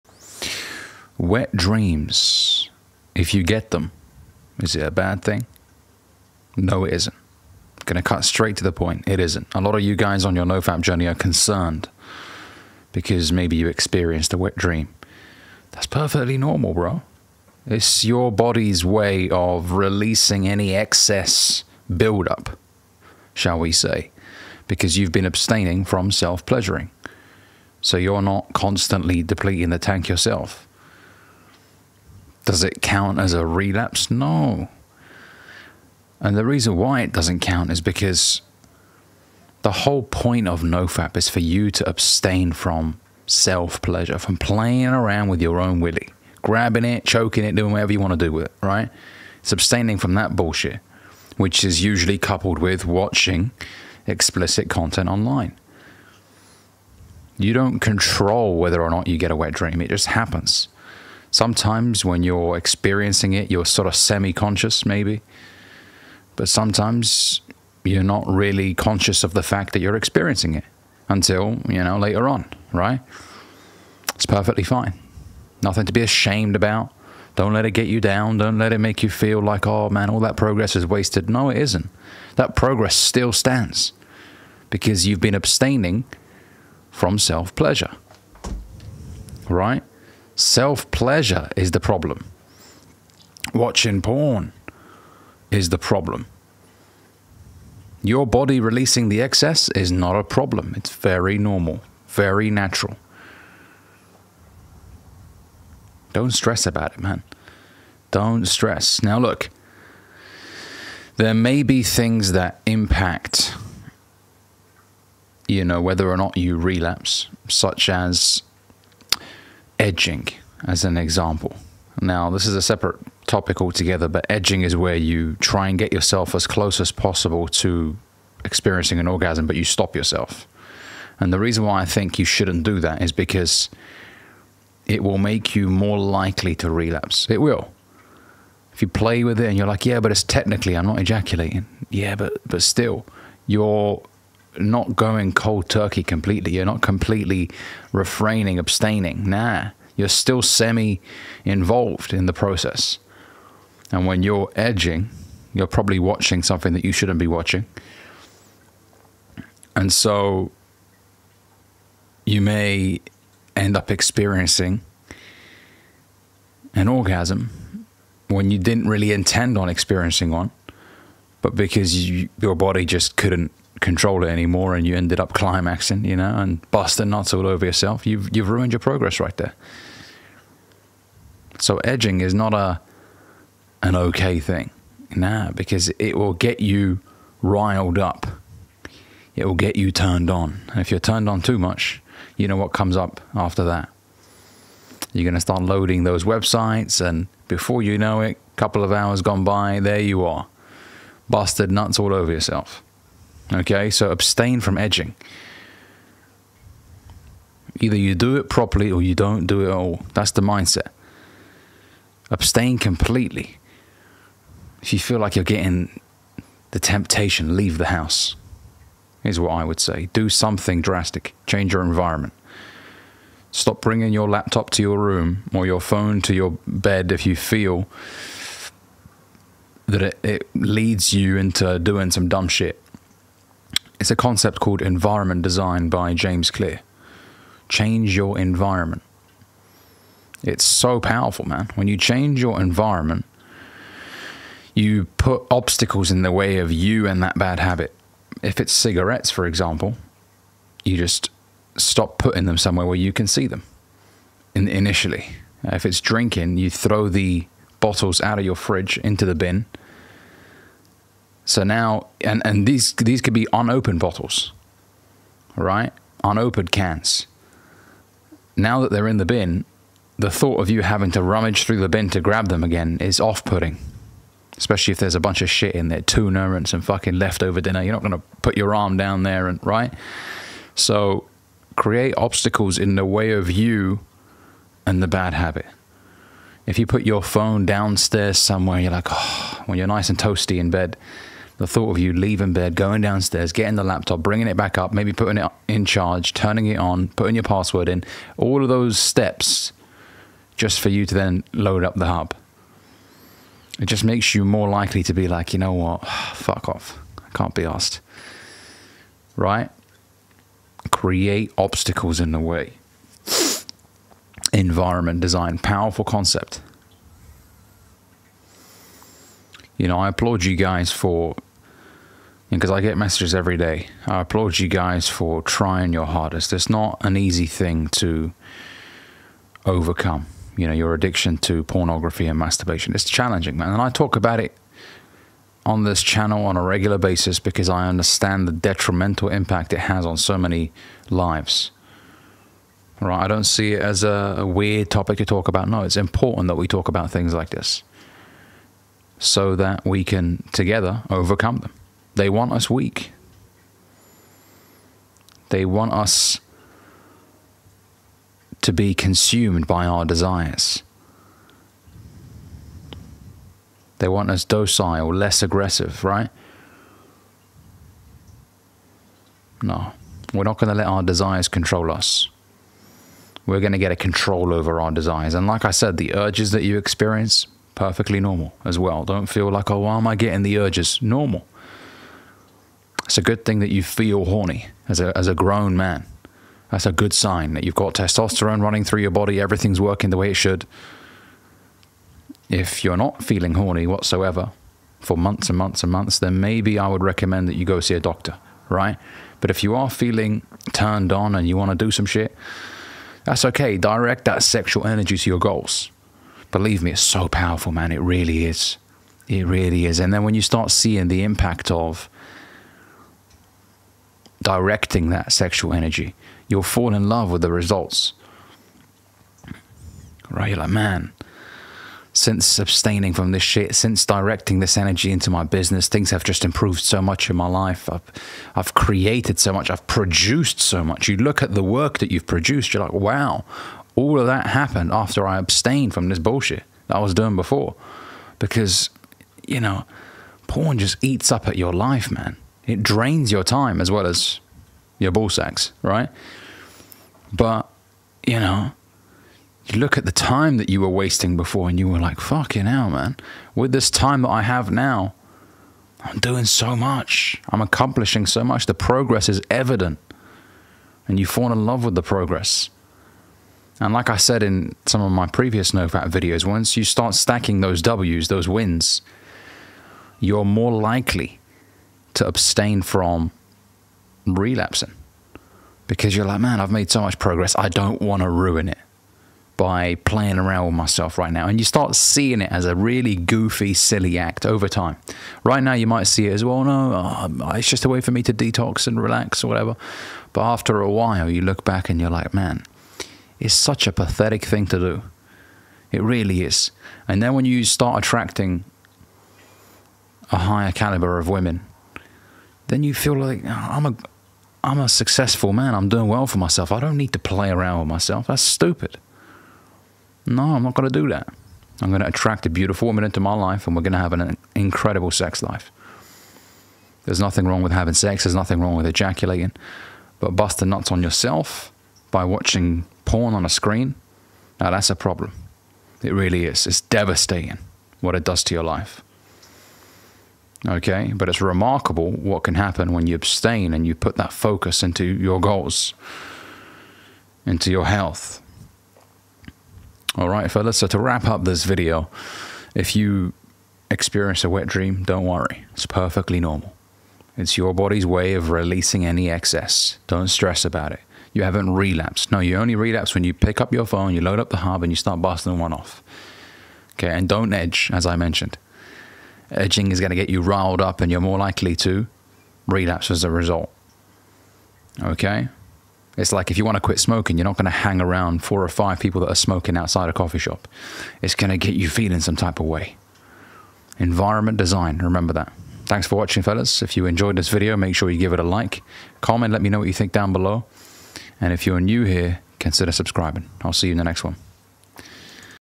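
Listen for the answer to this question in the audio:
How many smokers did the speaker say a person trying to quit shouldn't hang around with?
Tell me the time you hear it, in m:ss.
9:28.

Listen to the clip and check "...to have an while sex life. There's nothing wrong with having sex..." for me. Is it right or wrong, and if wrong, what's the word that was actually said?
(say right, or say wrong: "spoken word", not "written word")
wrong: "incredible", not "while".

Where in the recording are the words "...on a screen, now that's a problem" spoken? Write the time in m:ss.
8:43.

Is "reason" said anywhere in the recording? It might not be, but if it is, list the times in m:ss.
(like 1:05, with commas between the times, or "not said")
0:36, 2:11.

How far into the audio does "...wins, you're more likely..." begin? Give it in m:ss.
7:48.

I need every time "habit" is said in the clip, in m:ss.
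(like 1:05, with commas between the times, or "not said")
4:07, 4:45.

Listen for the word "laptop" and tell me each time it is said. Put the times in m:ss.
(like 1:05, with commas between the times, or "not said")
3:44, 4:53.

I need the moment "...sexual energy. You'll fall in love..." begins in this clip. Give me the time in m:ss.
6:55.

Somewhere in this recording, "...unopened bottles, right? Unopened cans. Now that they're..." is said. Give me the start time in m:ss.
4:23.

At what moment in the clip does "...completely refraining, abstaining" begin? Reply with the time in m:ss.
2:26.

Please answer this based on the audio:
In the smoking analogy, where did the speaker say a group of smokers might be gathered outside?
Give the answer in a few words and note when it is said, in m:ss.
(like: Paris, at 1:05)
A coffee shop, at 9:30.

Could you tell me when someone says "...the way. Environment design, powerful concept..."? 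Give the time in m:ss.
5:12.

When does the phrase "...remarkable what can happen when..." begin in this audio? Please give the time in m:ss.
8:51.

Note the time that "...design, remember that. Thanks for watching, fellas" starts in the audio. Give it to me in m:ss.
9:34.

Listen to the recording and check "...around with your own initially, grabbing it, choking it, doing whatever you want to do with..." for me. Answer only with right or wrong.
wrong.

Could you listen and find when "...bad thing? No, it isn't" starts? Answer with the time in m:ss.
0:04.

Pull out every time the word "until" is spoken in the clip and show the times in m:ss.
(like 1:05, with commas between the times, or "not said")
1:11.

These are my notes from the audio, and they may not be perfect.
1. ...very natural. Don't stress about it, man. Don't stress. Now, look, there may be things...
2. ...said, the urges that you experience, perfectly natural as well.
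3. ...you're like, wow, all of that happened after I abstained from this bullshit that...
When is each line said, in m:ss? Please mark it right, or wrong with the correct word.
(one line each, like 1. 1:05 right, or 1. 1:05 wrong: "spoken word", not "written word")
1. 1:42 right
2. 6:15 wrong: "normal", not "natural"
3. 7:12 right.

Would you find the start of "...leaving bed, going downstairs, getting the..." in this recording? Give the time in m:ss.
4:52.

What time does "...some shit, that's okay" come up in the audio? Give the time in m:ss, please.
6:41.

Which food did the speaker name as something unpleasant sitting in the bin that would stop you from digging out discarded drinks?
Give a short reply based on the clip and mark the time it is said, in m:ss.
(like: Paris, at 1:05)
Tuna, at 4:36.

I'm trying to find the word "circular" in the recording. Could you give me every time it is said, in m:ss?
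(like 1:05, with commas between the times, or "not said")
not said.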